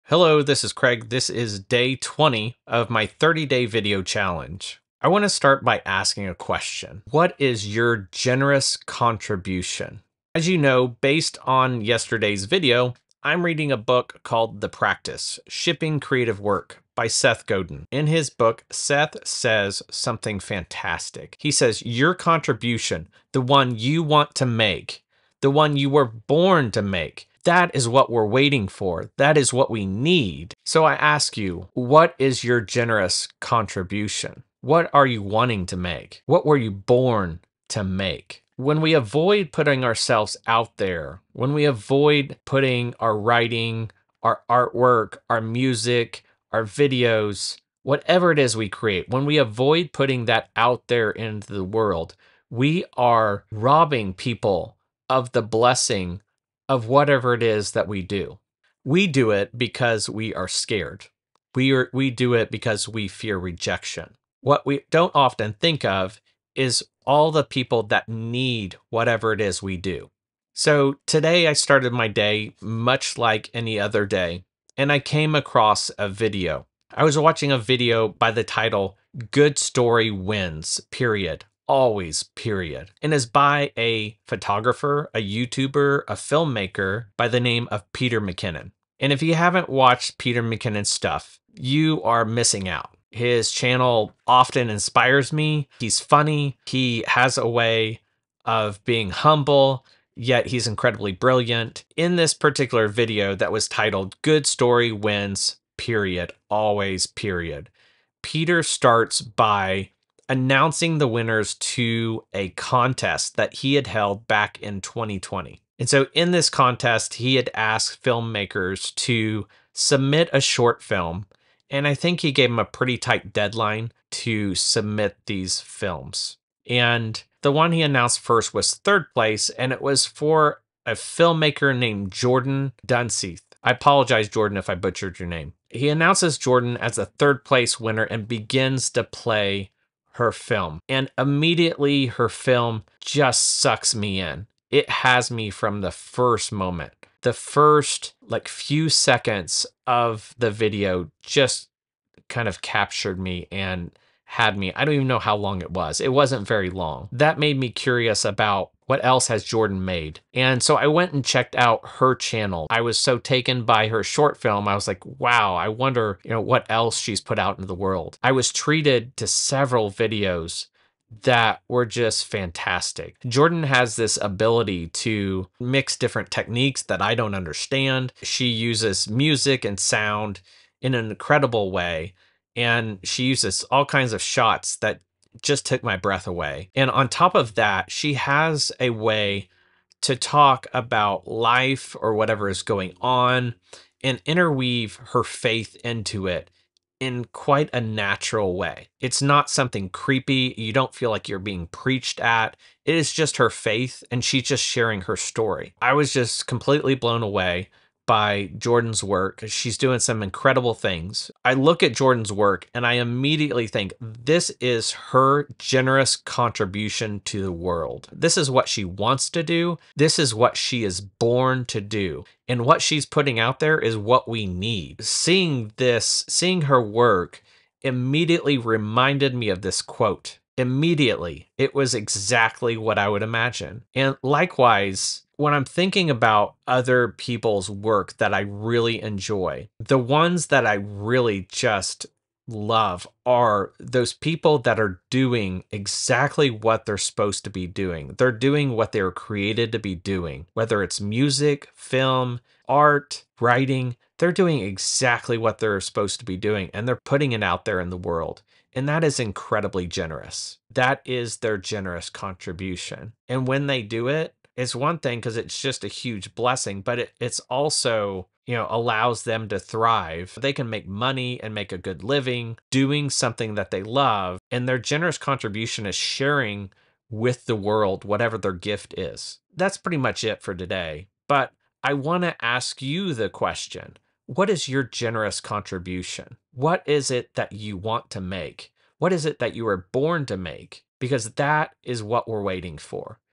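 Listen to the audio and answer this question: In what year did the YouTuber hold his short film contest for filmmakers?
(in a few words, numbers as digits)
2020.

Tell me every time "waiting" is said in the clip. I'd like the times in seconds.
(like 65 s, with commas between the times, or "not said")
28 s, 292 s.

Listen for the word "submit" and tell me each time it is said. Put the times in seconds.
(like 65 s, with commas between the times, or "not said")
119 s, 124 s.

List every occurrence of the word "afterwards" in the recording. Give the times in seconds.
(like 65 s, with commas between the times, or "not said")
not said.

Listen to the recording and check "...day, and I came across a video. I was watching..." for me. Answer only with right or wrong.
right.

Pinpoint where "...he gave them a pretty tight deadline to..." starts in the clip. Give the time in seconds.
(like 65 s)
122 s.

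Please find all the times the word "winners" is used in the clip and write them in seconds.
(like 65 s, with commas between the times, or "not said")
111 s, 137 s.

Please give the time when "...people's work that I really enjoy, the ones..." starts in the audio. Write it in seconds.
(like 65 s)
237 s.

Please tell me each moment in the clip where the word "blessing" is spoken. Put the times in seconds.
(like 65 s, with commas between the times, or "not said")
55 s, 266 s.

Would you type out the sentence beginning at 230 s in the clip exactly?
Immediately, it was exactly what I would imagine.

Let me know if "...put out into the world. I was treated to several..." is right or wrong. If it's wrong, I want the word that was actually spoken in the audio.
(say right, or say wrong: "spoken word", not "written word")
right.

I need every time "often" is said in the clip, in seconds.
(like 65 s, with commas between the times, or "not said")
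65 s, 94 s.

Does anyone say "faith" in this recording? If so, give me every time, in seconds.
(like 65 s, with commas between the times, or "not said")
195 s, 203 s.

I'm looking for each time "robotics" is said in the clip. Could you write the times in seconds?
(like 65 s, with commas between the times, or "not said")
not said.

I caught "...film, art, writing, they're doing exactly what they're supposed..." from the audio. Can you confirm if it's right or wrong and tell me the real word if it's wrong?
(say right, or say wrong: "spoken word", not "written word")
right.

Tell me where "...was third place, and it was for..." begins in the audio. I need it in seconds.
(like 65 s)
128 s.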